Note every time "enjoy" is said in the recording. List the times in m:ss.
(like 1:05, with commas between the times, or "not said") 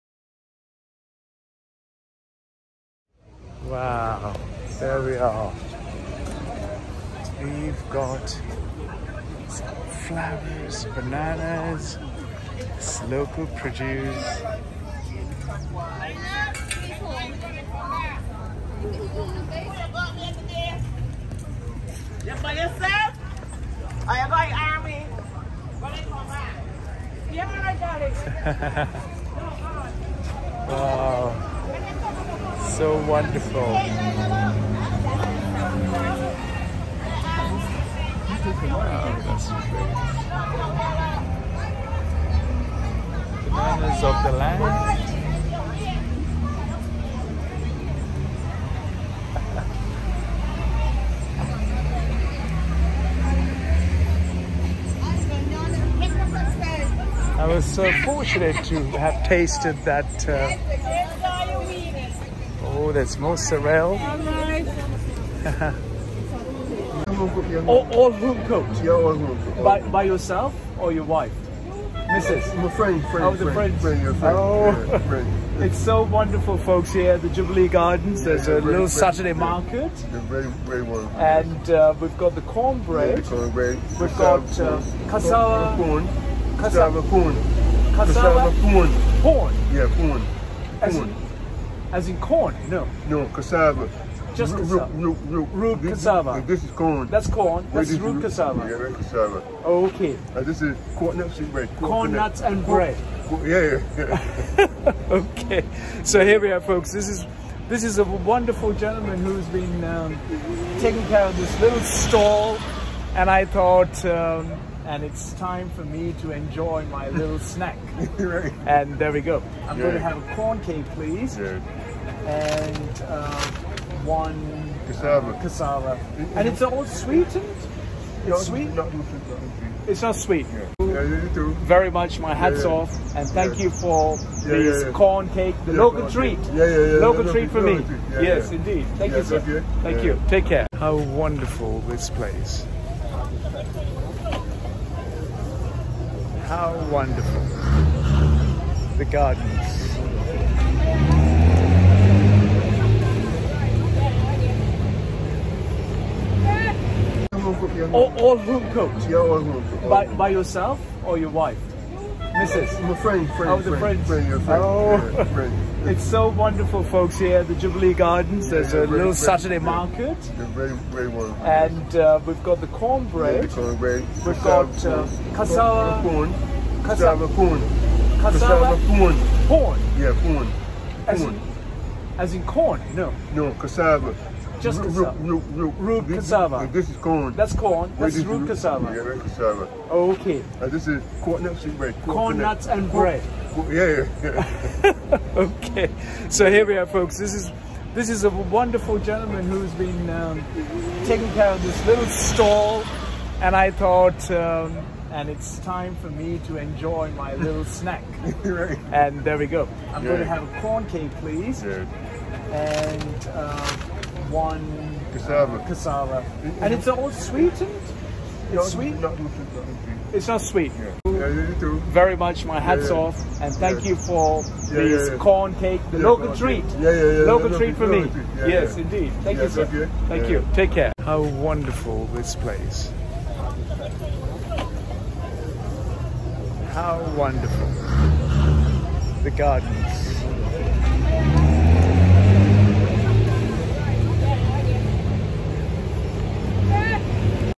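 1:56, 3:26.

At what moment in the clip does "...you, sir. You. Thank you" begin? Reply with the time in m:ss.
2:19.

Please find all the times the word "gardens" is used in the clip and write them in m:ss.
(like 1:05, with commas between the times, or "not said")
1:17, 2:29, 2:47, 3:59.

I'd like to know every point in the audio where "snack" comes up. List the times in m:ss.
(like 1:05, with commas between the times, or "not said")
1:57, 3:27.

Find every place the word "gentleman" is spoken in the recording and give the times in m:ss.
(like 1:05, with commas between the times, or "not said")
1:48, 3:18.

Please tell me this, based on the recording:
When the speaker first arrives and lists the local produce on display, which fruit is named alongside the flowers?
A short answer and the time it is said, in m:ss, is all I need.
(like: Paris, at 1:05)
Bananas, at 0:10.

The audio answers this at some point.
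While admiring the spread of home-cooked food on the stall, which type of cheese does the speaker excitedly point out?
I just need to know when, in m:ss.
1:03.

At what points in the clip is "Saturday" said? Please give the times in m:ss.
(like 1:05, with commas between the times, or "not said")
1:18, 2:49.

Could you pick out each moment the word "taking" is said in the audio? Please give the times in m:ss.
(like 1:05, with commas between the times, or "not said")
1:50, 3:21.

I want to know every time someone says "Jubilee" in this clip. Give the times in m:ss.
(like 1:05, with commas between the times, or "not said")
1:17, 2:47.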